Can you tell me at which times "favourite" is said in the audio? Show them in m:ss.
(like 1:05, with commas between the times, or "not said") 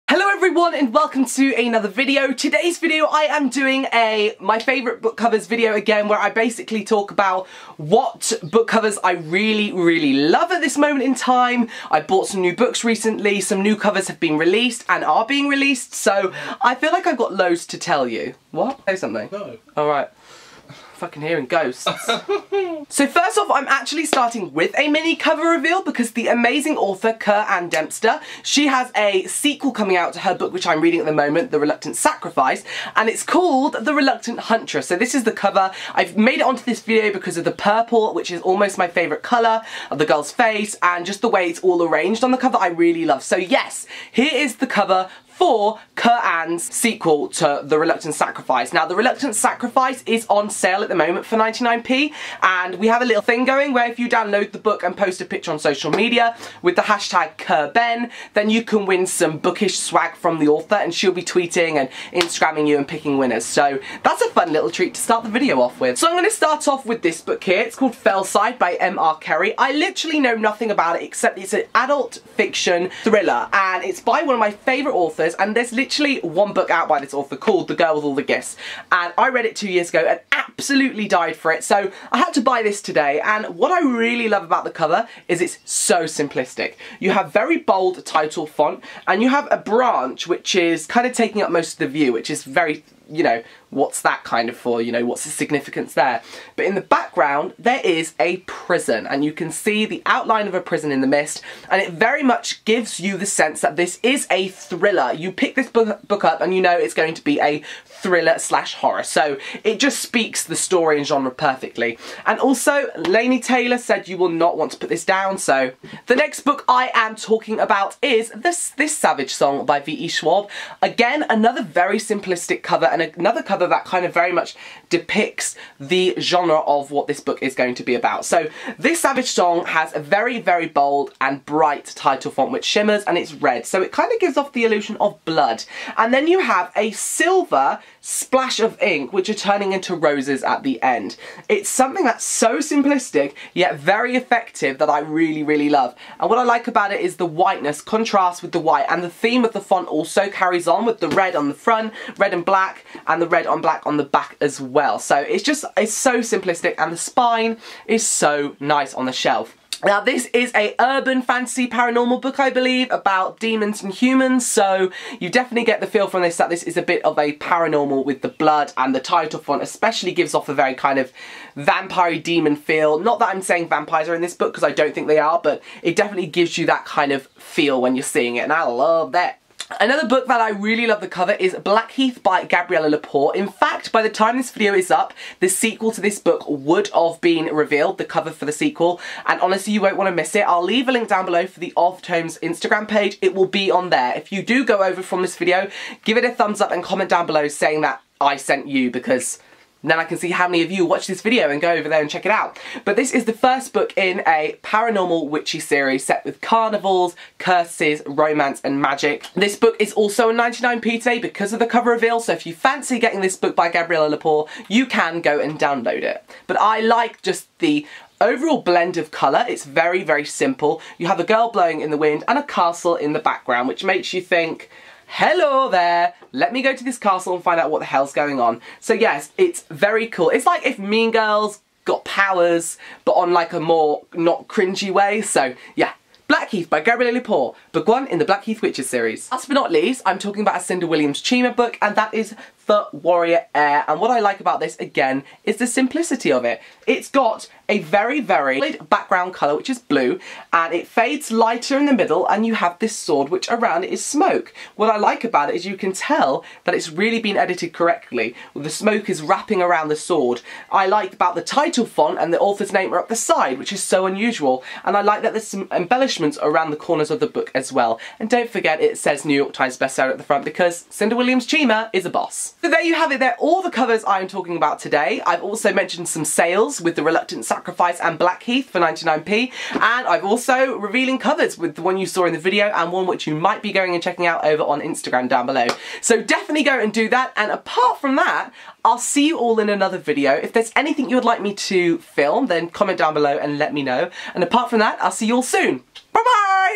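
0:04, 0:38, 1:14.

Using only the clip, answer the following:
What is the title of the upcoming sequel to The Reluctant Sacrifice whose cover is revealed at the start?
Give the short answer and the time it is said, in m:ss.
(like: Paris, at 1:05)
The Reluctant Huntress, at 0:33.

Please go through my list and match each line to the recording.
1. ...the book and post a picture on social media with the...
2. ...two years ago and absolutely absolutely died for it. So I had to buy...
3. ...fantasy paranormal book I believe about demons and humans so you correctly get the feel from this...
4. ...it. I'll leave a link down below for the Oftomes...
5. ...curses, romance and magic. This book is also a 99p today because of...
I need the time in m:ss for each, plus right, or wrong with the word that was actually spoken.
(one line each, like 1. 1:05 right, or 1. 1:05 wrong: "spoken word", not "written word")
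1. 0:54 right
2. 1:19 right
3. 2:41 wrong: "definitely", not "correctly"
4. 3:10 right
5. 3:27 right.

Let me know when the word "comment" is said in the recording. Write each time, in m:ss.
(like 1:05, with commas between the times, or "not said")
3:16, 4:52.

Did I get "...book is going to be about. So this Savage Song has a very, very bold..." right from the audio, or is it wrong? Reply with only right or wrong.
right.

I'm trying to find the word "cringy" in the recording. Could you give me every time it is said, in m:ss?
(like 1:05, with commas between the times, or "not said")
3:54.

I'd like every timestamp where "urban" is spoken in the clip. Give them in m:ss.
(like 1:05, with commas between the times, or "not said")
2:40.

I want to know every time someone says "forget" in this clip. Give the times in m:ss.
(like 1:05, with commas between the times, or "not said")
4:28.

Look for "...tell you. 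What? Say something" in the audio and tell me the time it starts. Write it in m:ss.
0:17.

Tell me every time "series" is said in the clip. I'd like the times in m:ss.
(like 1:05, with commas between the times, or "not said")
3:25, 3:58.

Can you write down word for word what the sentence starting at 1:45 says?
You pick this book up, and you know it's going to be a thriller slash horror.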